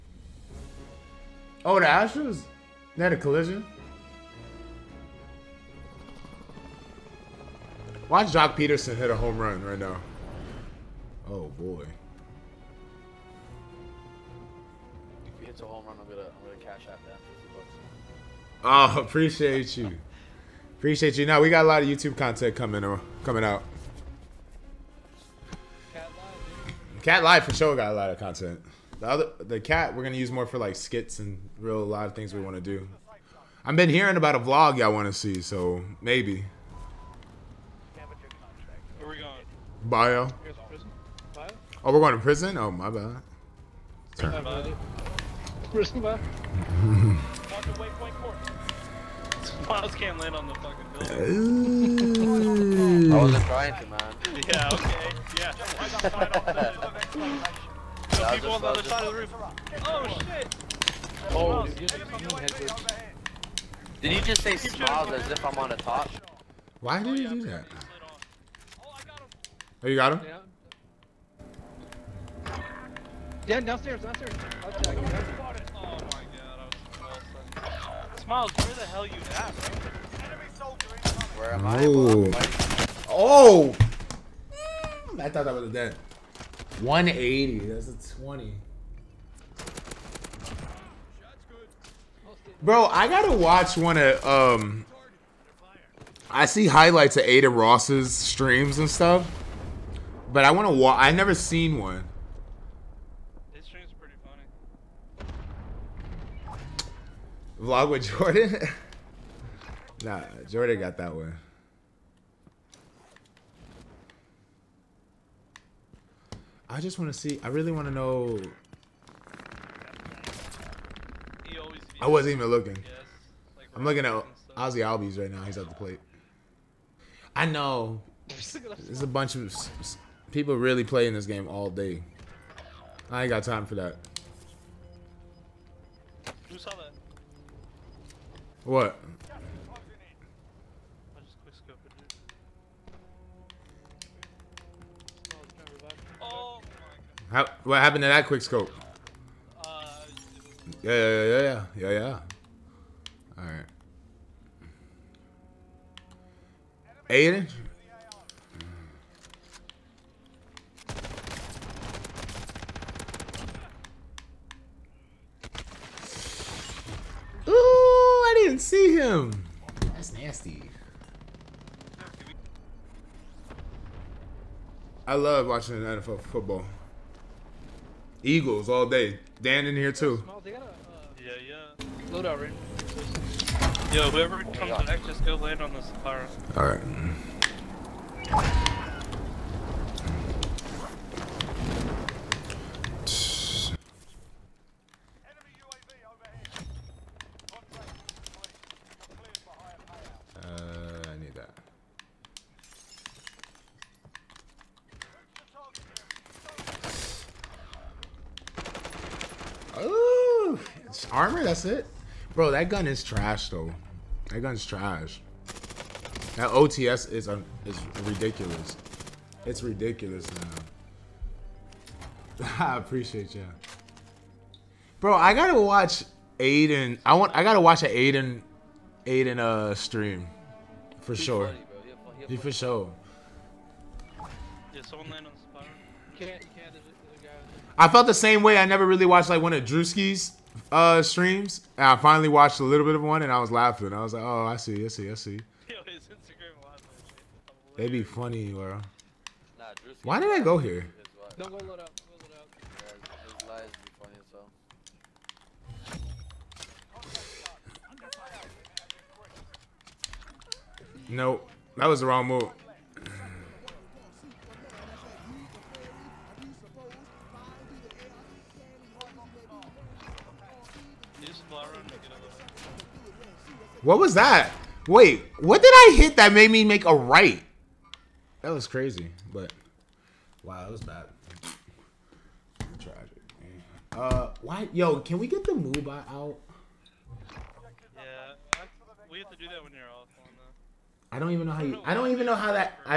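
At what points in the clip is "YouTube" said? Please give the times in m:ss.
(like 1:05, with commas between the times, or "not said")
0:21.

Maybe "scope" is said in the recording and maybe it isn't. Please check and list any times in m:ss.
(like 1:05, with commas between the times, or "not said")
2:28.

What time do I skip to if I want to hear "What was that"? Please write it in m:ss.
4:33.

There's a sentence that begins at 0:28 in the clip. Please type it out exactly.
The other the cat we're gonna use more for like skits and real a lot of things we want to do.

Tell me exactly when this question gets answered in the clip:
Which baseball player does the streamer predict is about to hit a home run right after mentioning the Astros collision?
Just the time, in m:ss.
0:08.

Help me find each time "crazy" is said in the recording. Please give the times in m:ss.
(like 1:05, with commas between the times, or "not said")
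4:38.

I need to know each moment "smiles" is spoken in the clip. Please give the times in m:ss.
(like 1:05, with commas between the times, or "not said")
1:04, 1:18.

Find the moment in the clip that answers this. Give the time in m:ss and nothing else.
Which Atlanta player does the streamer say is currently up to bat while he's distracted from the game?
2:04.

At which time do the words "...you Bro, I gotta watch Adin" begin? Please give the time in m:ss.
3:43.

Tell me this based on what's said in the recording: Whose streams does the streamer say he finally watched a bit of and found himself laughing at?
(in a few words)
Drewski.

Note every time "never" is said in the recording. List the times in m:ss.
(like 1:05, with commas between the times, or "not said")
1:41, 3:58.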